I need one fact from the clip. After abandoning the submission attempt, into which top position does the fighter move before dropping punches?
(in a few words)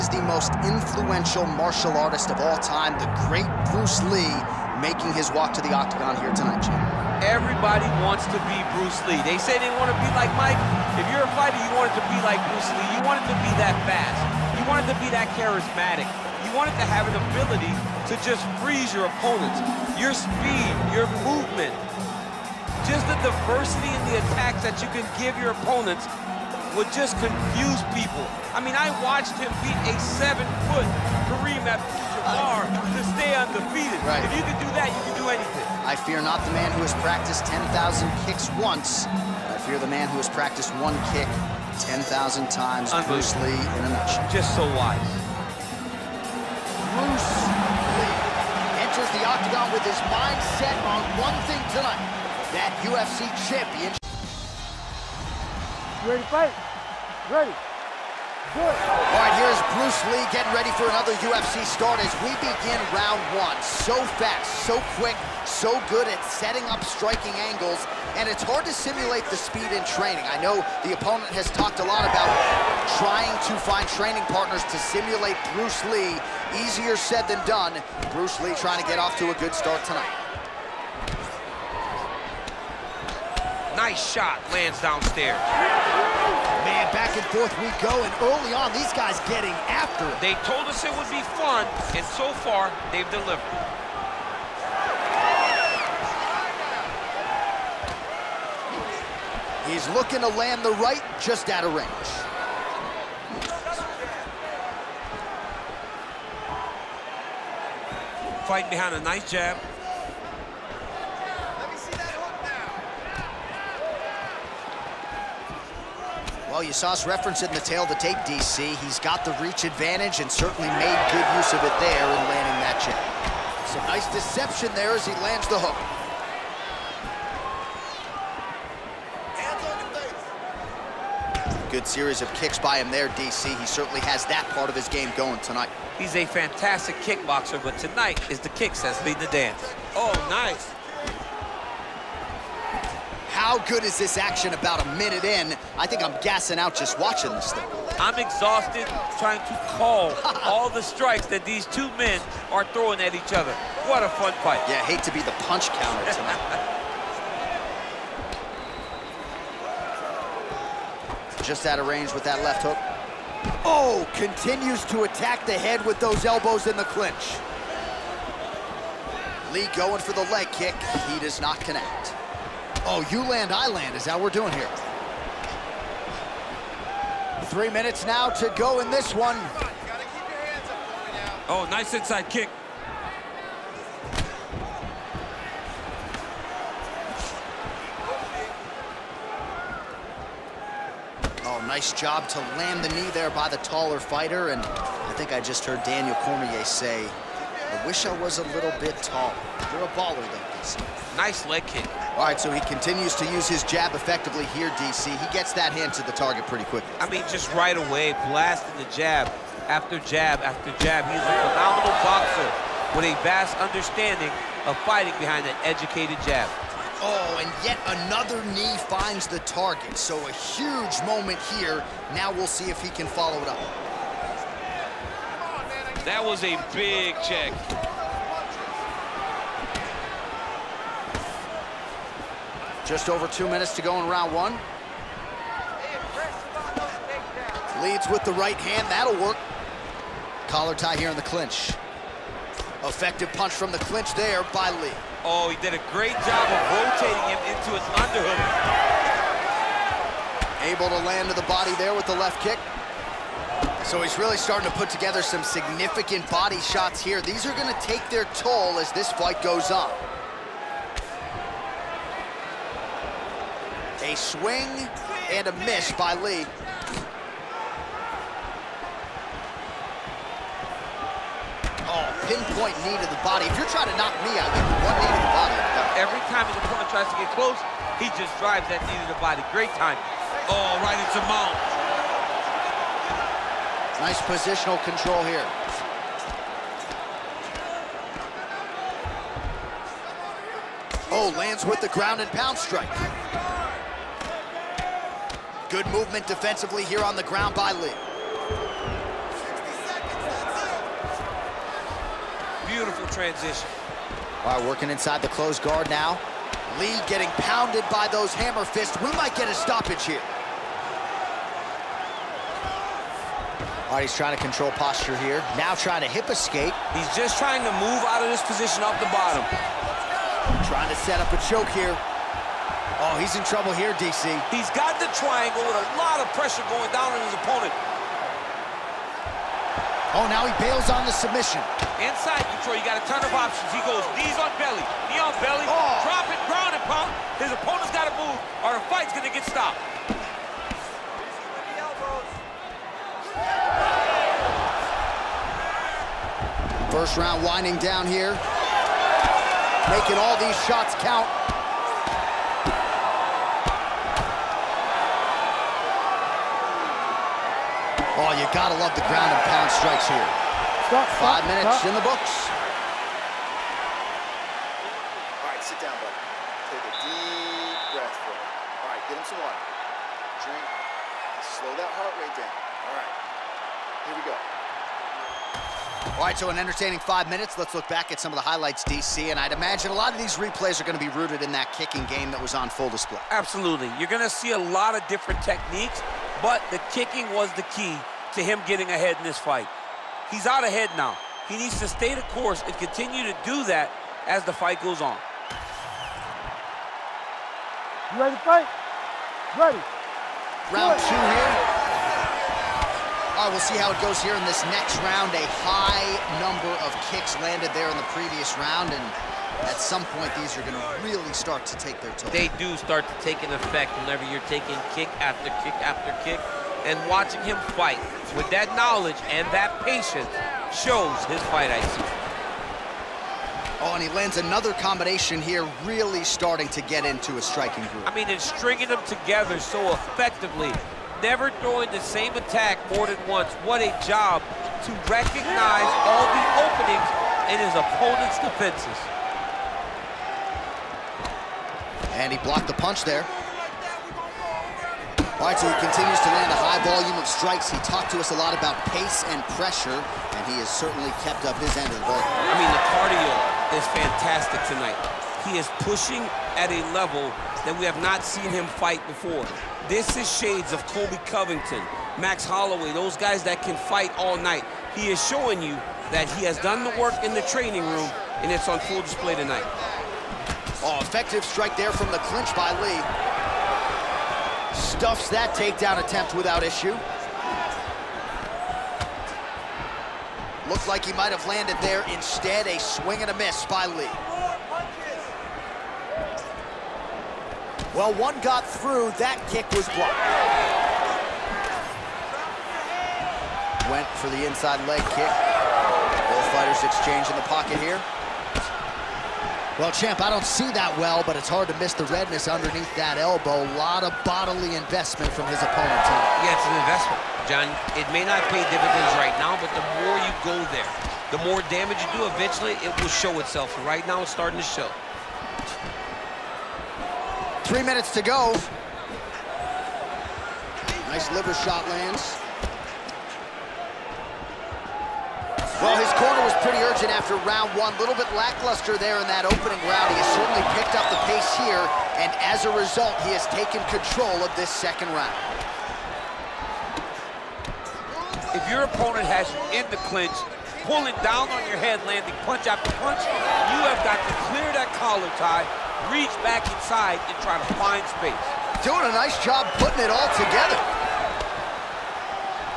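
knee on belly.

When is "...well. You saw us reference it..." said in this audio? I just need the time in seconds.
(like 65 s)
116 s.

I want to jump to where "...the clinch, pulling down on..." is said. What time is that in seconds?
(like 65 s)
539 s.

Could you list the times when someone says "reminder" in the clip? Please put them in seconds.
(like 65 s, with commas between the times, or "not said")
not said.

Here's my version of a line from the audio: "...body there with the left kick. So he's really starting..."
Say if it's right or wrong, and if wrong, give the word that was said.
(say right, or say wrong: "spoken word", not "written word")
right.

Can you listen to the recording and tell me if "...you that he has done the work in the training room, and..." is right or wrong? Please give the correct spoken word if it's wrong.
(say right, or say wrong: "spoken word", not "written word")
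right.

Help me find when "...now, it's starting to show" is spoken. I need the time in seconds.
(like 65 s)
514 s.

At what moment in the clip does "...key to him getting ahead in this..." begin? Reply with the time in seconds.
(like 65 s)
387 s.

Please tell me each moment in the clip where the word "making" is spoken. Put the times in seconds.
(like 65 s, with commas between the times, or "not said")
4 s, 349 s.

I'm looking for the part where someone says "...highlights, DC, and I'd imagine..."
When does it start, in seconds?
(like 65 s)
378 s.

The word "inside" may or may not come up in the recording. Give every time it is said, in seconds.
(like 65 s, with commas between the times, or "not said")
181 s, 304 s, 331 s, 494 s, 546 s.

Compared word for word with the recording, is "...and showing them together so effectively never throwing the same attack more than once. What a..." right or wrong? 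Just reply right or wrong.
wrong.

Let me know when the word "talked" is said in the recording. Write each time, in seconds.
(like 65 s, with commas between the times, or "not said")
71 s, 447 s.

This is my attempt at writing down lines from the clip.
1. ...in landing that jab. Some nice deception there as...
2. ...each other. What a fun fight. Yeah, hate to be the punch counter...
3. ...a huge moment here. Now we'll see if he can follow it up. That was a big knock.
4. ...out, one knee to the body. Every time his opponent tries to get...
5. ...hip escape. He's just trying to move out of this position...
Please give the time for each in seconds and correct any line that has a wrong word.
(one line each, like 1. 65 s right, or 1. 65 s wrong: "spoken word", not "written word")
1. 122 s right
2. 153 s right
3. 220 s wrong: "check", not "knock"
4. 274 s right
5. 316 s right.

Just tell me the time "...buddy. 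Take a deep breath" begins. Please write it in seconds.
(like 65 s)
365 s.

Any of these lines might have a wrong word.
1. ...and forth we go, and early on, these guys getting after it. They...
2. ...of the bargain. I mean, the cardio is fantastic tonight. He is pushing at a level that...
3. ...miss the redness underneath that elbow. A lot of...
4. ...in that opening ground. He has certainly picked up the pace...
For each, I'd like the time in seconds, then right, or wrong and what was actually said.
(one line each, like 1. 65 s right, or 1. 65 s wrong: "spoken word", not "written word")
1. 87 s right
2. 451 s right
3. 501 s right
4. 529 s wrong: "round", not "ground".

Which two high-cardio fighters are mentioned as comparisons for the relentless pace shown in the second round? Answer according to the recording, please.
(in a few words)
Colby Covington, Max Holloway.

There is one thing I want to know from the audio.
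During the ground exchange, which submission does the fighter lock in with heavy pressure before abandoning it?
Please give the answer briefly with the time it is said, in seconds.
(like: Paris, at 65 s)
triangle, at 325 s.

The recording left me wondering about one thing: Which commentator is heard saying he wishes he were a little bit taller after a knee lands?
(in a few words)
Daniel Cormier.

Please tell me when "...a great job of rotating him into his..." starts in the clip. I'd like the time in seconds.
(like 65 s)
245 s.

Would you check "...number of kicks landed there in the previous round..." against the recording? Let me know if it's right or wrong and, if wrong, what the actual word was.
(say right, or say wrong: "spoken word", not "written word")
right.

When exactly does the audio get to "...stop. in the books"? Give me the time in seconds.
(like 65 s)
361 s.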